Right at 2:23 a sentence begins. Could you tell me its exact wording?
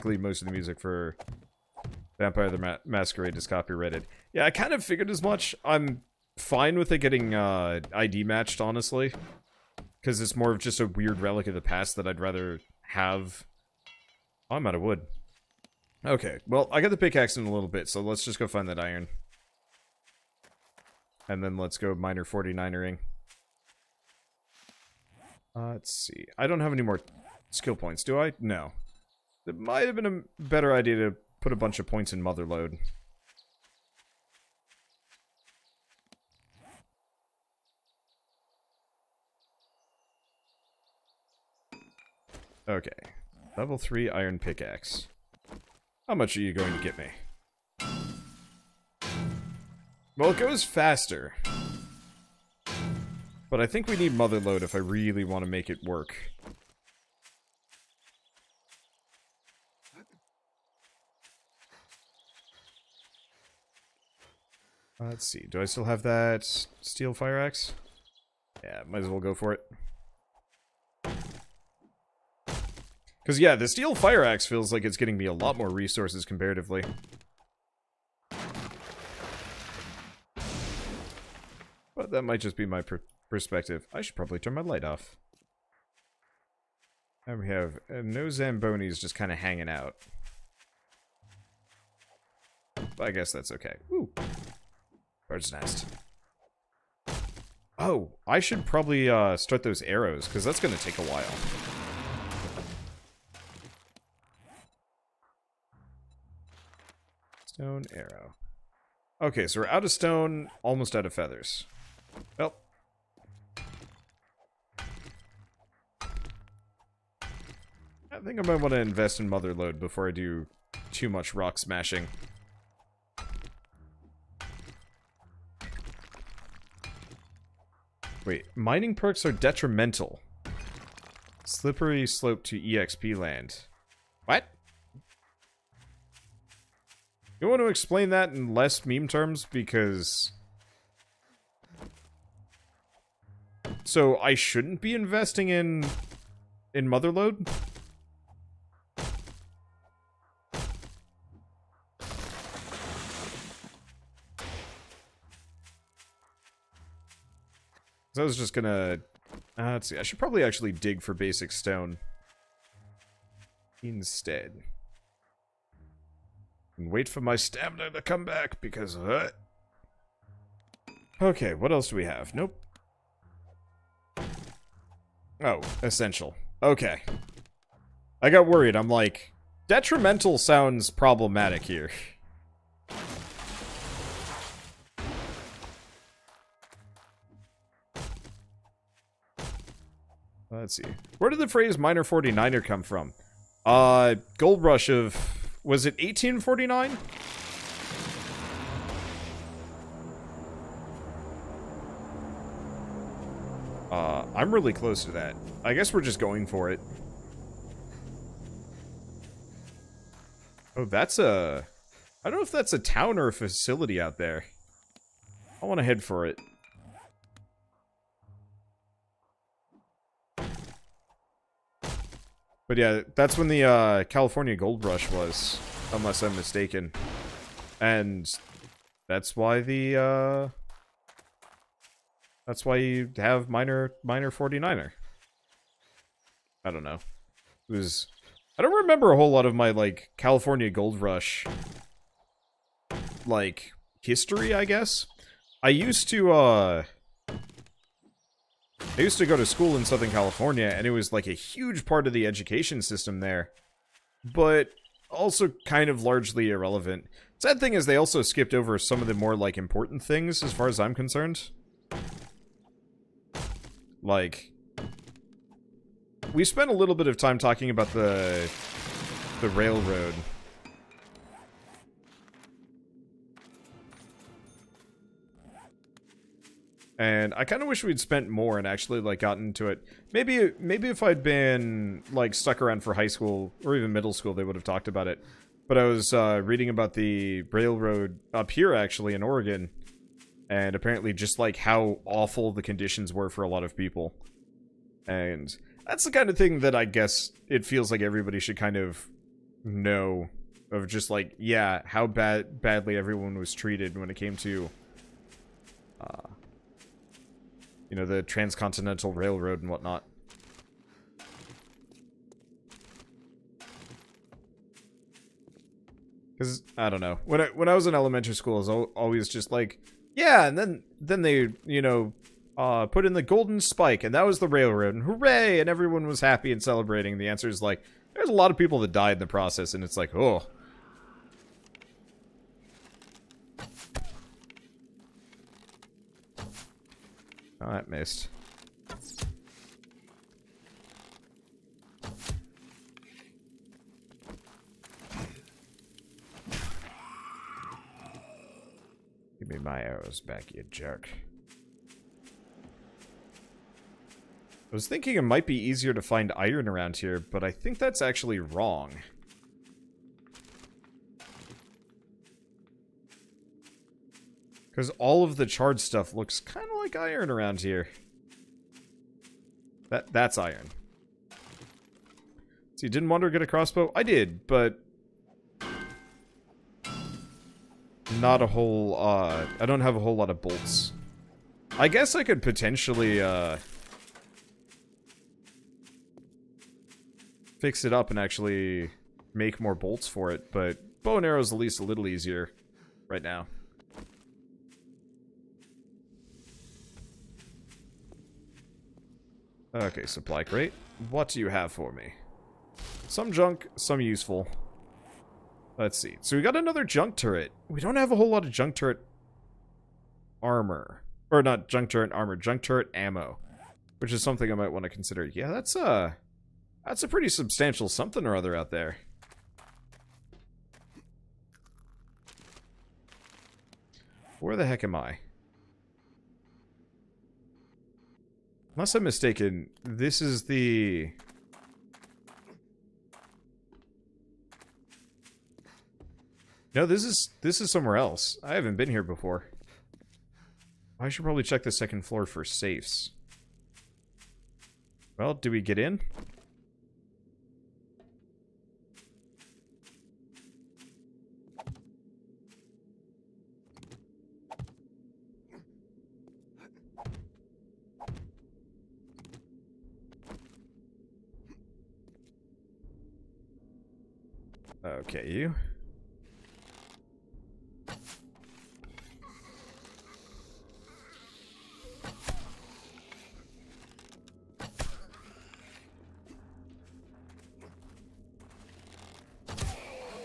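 So, I shouldn't be investing in...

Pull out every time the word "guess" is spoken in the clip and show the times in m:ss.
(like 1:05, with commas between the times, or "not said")
1:33, 3:25, 4:04, 4:56, 6:21.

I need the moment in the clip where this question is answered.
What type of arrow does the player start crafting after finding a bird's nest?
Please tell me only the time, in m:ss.
1:47.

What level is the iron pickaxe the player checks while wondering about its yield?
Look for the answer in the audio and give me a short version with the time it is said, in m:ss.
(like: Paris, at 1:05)
3, at 0:43.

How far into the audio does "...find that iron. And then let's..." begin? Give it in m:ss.
0:18.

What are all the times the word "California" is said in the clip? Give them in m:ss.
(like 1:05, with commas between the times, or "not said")
3:44, 4:00, 4:10.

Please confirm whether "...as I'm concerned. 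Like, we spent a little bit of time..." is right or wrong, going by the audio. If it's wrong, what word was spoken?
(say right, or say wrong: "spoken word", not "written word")
right.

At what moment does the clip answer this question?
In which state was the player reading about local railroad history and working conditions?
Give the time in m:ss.
4:49.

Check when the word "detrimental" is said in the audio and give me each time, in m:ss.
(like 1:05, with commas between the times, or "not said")
2:09, 2:59.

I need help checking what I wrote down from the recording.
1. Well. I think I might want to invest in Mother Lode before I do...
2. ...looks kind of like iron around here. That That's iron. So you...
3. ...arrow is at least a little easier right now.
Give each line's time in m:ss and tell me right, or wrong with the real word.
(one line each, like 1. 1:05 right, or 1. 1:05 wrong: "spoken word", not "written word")
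1. 1:52 right
2. 6:06 right
3. 6:31 right.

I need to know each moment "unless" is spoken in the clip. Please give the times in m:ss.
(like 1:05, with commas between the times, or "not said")
3:45, 7:08.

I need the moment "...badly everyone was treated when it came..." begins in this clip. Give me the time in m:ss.
5:02.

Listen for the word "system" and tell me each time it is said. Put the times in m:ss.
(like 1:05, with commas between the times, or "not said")
4:12.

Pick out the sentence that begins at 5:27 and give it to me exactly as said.
And the answer is like, there's a lot of people that died in the process, and it's like, oh, Oh, that missed.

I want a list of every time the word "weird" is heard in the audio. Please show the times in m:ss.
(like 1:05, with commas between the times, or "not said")
0:10.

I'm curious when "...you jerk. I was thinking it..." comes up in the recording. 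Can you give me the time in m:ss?
5:50.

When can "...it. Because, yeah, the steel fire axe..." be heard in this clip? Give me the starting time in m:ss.
1:09.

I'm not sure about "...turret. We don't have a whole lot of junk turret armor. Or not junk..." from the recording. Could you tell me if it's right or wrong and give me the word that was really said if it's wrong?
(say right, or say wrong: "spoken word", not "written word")
right.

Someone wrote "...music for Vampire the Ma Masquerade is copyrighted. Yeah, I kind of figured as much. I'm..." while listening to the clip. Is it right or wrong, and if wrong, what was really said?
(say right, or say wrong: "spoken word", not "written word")
right.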